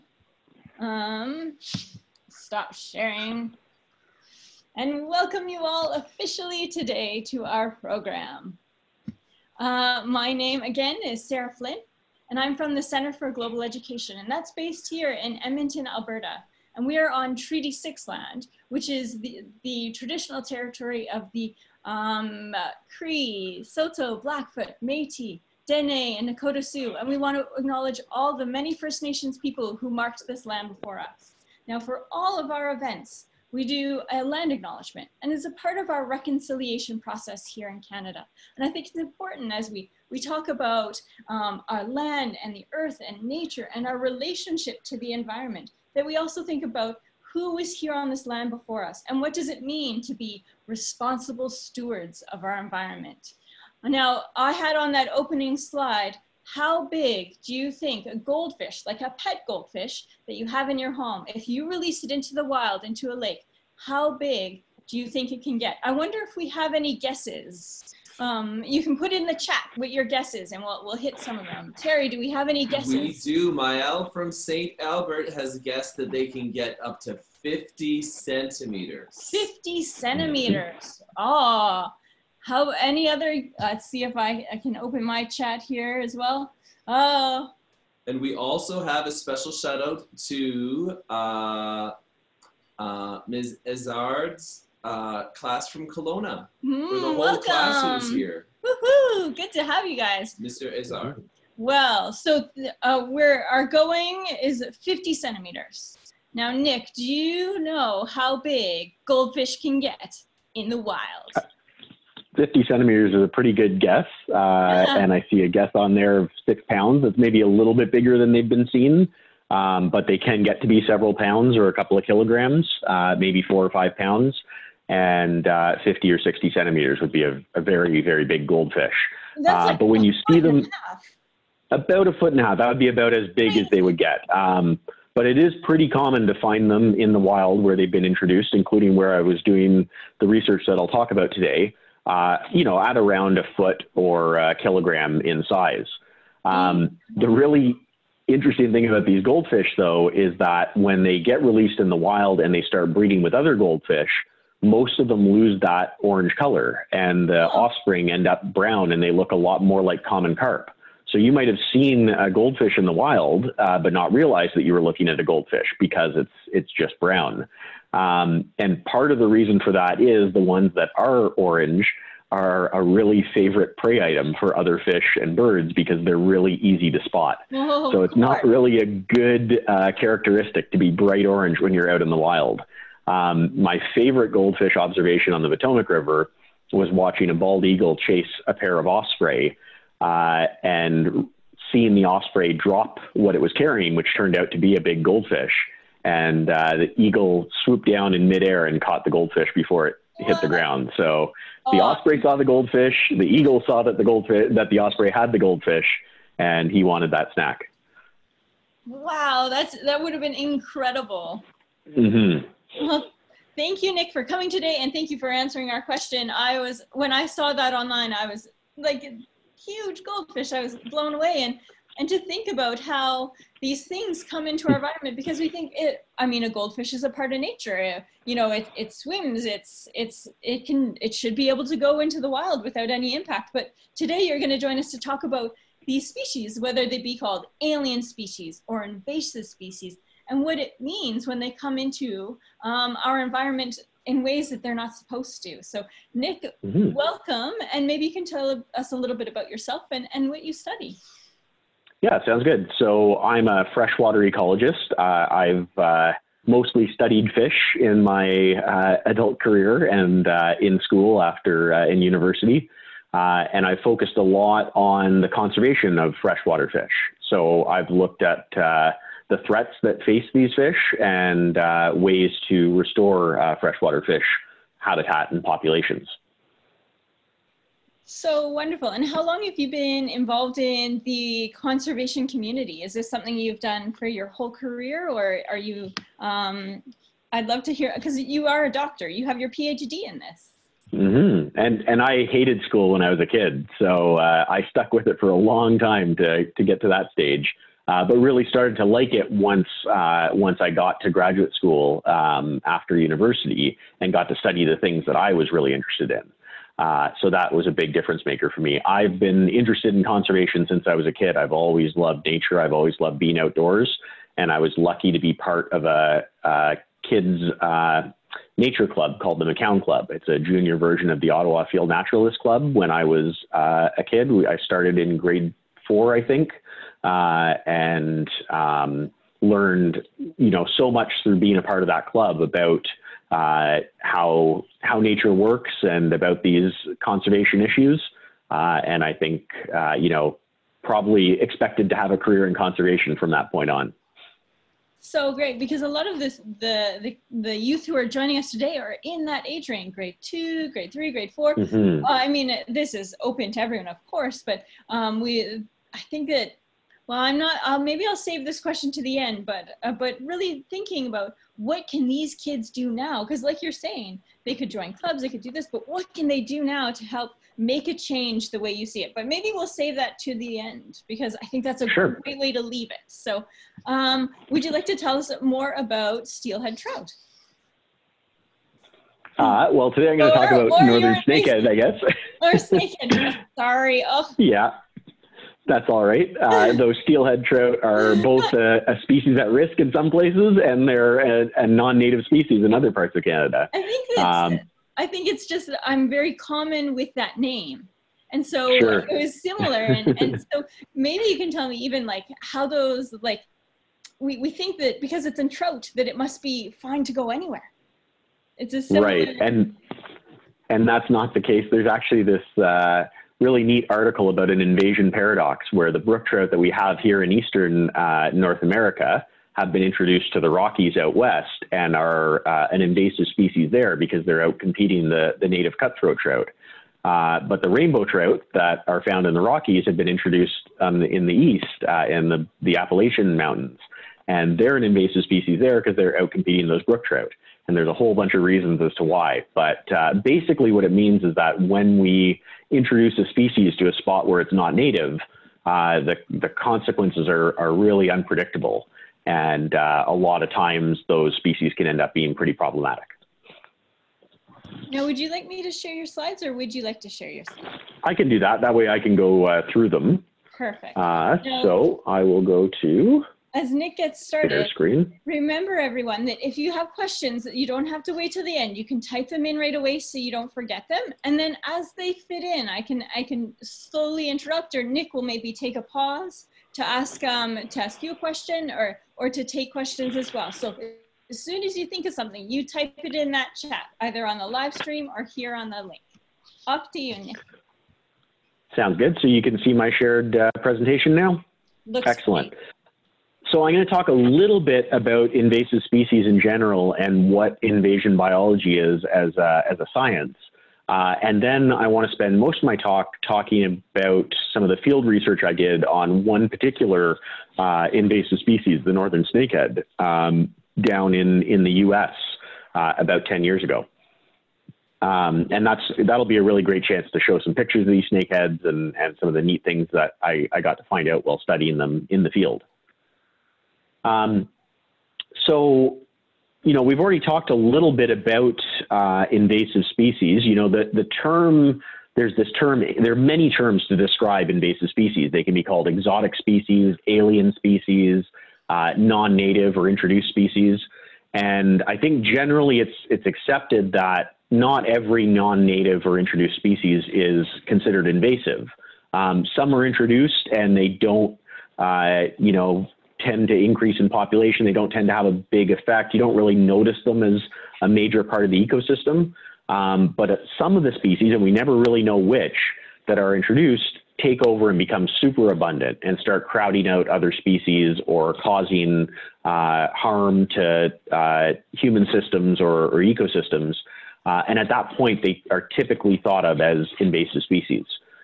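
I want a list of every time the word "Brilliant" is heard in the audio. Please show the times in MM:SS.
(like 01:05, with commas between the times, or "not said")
not said.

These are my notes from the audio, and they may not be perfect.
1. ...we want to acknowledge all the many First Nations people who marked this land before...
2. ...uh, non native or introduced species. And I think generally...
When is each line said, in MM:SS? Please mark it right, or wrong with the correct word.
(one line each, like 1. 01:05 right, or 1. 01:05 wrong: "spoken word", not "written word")
1. 00:27 right
2. 08:58 right.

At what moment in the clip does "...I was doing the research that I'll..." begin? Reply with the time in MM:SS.
02:19.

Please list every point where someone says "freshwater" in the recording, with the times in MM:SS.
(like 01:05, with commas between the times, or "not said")
04:13, 04:26, 04:33.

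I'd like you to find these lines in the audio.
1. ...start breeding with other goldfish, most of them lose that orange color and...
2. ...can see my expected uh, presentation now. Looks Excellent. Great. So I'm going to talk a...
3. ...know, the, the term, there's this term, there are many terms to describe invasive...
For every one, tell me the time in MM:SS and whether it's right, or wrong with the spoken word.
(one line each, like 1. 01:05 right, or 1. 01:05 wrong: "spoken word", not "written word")
1. 02:32 right
2. 08:09 wrong: "shared", not "expected"
3. 08:50 right.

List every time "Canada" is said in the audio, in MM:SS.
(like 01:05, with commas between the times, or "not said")
00:37, 06:33.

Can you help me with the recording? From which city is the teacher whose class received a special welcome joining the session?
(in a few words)
Kelowna.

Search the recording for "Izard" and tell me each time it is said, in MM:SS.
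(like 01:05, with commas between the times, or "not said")
01:33, 01:40.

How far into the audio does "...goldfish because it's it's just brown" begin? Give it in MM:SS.
02:45.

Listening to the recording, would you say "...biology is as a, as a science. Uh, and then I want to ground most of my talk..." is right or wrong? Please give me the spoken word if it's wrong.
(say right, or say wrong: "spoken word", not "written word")
wrong: "spend", not "ground".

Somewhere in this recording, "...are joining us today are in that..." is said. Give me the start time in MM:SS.
05:47.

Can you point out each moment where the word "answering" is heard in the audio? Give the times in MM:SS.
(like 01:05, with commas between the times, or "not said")
03:35.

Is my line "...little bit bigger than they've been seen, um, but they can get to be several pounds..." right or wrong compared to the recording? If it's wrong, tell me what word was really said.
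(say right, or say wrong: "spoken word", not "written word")
right.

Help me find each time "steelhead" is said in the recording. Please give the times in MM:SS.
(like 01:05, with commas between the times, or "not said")
06:16, 06:27.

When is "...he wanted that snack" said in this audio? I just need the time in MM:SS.
03:26.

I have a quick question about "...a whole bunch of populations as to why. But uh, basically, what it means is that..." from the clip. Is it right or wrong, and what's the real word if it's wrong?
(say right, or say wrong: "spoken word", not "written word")
wrong: "reasons", not "populations".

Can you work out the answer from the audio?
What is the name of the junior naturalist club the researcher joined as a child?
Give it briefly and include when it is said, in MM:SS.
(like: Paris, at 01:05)
Macoun Club, at 05:19.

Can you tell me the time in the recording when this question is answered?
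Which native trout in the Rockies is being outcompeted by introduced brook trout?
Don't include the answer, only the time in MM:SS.
07:05.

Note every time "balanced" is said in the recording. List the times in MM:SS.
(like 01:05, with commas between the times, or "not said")
not said.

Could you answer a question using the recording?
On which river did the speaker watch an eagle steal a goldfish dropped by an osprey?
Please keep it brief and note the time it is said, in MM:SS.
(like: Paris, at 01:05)
Potomac River, at 03:05.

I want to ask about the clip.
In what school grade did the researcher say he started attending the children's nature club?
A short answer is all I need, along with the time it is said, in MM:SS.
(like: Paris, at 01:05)
grade four, at 05:25.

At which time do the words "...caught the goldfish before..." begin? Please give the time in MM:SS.
03:18.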